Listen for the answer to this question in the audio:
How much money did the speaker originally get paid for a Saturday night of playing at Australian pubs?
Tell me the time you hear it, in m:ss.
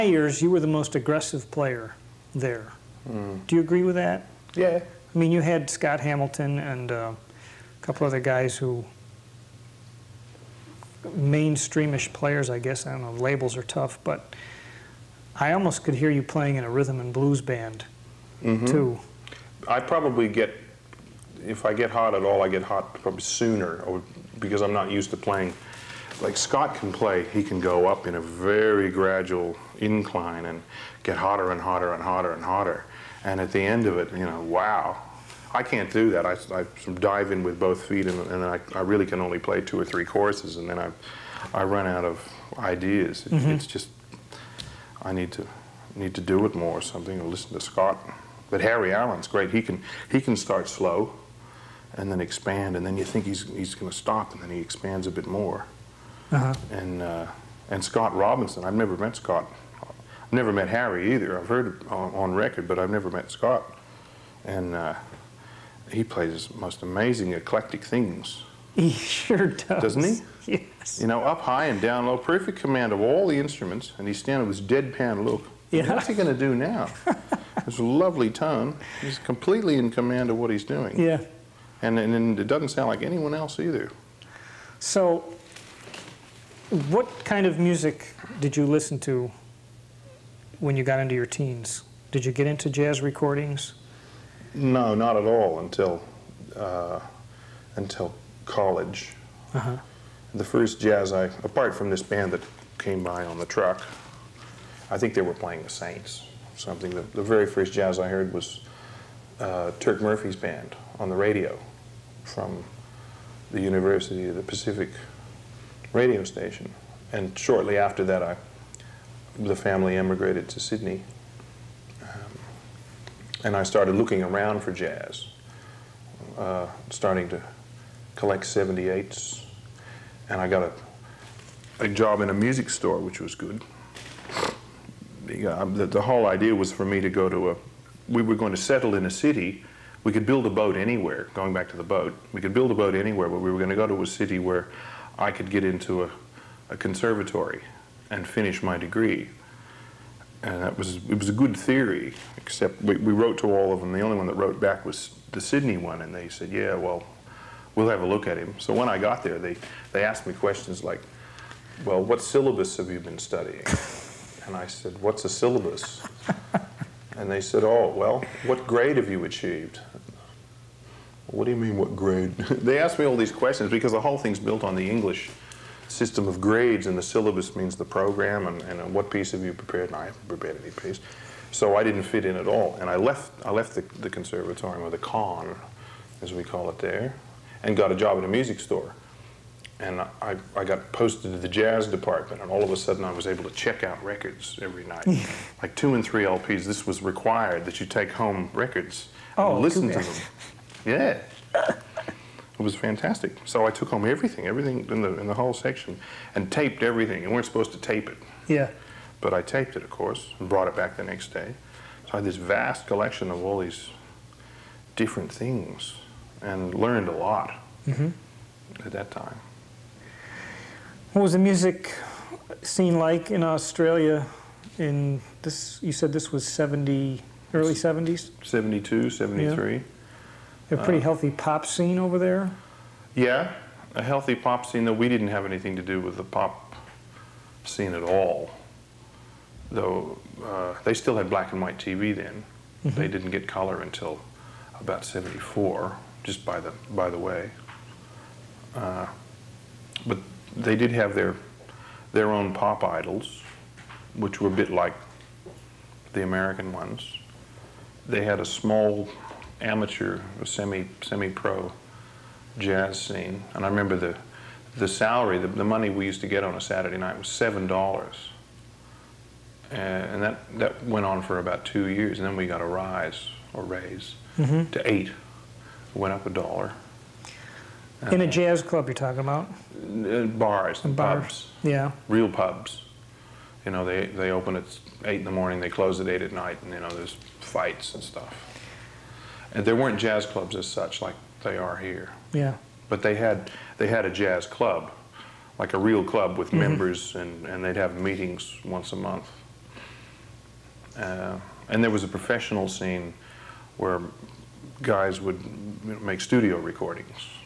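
4:27.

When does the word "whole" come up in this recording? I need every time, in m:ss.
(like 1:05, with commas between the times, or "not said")
2:16, 2:54, 3:25.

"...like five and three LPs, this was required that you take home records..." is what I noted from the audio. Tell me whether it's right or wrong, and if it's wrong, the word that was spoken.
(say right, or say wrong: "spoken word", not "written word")
wrong: "two", not "five".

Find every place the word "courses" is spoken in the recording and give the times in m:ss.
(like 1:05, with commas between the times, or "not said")
0:40, 3:29.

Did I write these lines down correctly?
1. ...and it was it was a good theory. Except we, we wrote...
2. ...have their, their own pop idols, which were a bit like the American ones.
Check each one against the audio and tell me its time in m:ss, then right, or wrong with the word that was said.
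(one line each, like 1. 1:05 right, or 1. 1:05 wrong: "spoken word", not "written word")
1. 2:30 right
2. 4:10 right.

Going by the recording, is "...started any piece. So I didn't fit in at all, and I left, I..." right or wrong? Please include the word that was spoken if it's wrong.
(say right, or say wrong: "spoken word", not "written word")
wrong: "prepared", not "started".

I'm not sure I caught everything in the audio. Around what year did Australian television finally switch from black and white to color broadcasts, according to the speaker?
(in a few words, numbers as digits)
74.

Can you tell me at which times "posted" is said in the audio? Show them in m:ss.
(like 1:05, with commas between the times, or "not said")
3:10.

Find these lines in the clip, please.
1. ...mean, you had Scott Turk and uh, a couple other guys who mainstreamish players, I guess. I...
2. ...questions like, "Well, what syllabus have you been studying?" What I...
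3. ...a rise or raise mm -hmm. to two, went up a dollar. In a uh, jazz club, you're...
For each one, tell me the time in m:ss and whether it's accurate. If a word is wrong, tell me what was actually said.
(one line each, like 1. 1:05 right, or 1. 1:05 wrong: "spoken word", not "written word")
1. 0:05 wrong: "Hamilton", not "Turk"
2. 2:40 wrong: "And", not "What"
3. 4:32 wrong: "eight", not "two".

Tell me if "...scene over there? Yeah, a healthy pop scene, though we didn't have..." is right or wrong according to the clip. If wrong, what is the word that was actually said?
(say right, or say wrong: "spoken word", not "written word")
right.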